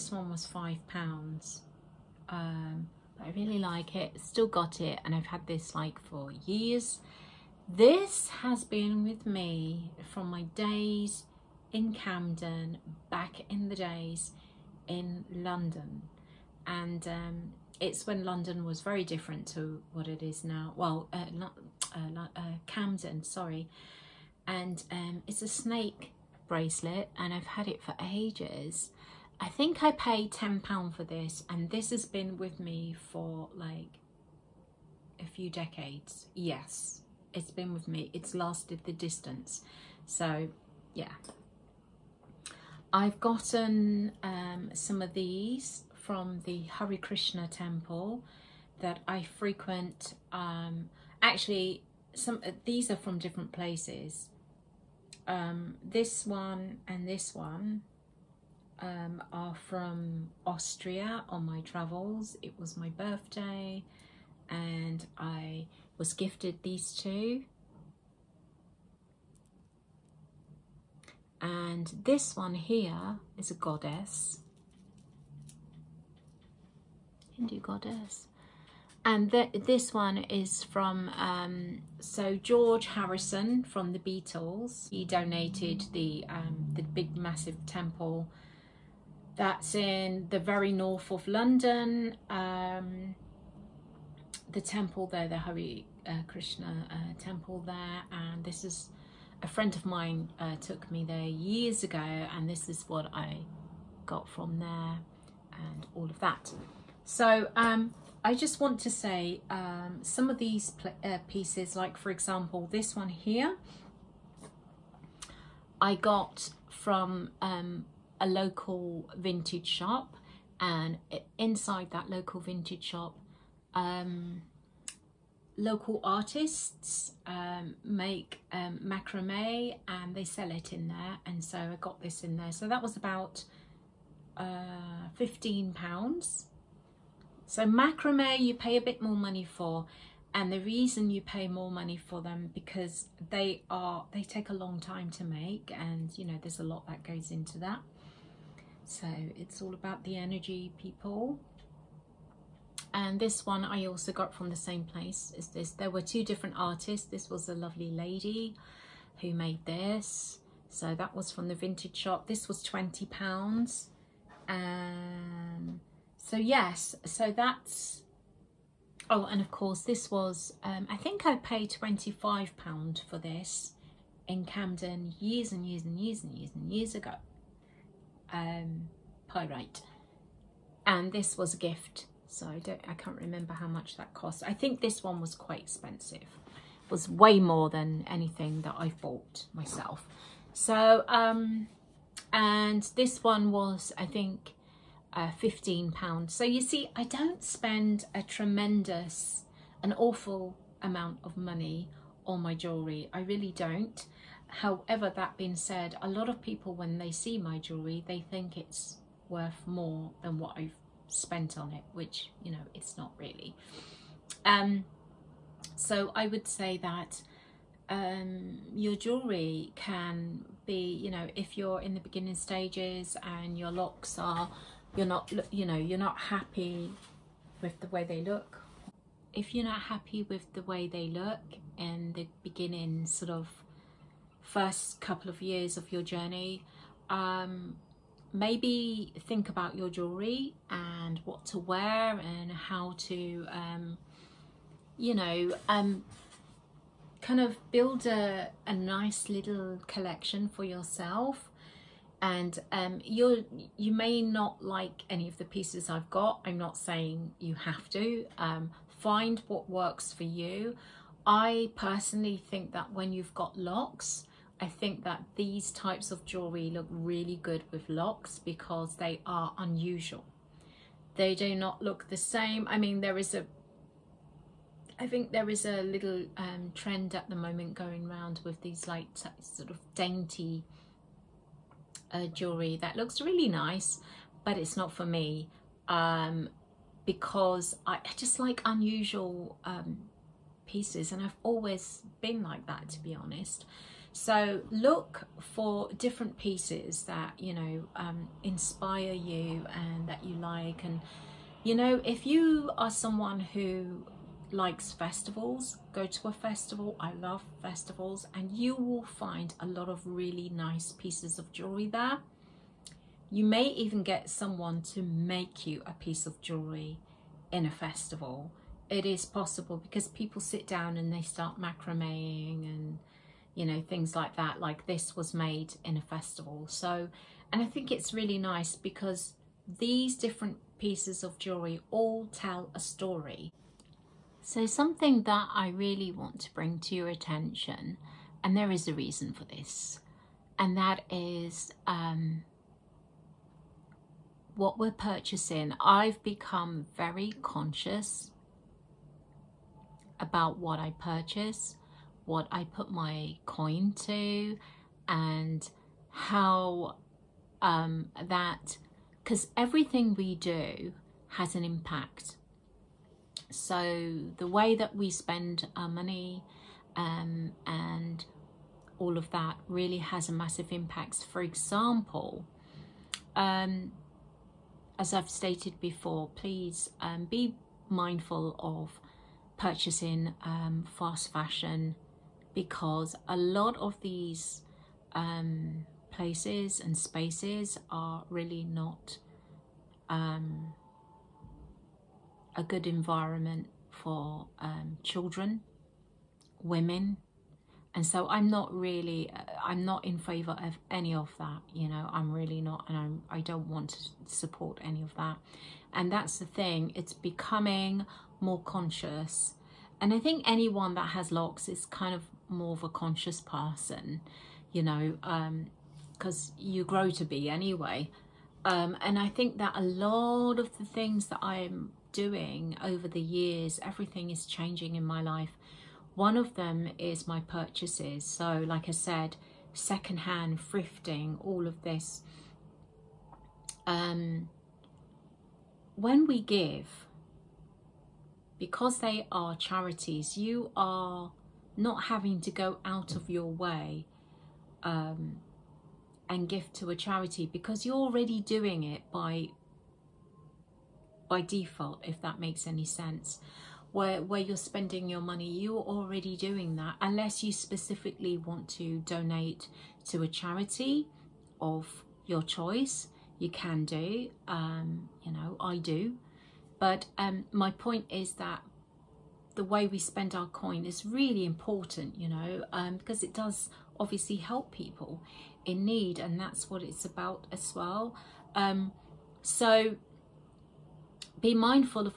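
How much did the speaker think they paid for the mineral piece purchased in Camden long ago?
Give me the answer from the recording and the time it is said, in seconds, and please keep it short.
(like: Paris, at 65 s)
£25, at 171 s.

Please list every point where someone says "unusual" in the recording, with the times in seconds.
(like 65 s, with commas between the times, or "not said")
269 s, 288 s.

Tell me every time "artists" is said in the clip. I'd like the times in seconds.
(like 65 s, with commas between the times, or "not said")
126 s, 156 s.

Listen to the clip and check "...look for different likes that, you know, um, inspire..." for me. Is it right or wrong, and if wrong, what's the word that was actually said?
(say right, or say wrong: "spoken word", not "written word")
wrong: "pieces", not "likes".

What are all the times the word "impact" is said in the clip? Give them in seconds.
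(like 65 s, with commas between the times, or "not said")
361 s, 370 s.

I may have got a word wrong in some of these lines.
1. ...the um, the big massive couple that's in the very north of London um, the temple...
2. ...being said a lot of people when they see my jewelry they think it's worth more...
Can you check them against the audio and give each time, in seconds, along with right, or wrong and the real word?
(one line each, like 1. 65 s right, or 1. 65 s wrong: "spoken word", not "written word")
1. 85 s wrong: "temple", not "couple"
2. 205 s right.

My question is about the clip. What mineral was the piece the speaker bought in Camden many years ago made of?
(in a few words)
Pyrite.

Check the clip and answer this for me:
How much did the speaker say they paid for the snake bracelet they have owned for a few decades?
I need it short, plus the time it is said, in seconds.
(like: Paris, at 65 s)
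£10, at 30 s.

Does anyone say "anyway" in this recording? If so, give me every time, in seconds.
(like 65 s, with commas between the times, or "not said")
417 s.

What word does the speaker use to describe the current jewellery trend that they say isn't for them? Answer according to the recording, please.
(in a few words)
Dainty.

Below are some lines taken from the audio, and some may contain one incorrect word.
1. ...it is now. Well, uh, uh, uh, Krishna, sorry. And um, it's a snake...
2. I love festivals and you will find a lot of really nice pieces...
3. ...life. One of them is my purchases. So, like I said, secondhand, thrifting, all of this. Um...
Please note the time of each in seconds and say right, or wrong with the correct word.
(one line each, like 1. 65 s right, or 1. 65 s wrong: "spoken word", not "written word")
1. 20 s wrong: "Camden", not "Krishna"
2. 306 s right
3. 425 s right.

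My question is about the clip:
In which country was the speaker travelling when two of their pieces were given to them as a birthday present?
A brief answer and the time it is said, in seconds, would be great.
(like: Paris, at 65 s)
Austria, at 60 s.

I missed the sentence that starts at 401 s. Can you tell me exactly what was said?
You know, I'm really not, and I'm, I don't want to support any of that.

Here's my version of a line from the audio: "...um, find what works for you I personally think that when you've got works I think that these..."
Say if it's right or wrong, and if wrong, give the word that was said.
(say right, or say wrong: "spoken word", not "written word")
wrong: "locks", not "works".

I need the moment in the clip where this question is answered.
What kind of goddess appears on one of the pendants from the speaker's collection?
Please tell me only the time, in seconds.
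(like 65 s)
77 s.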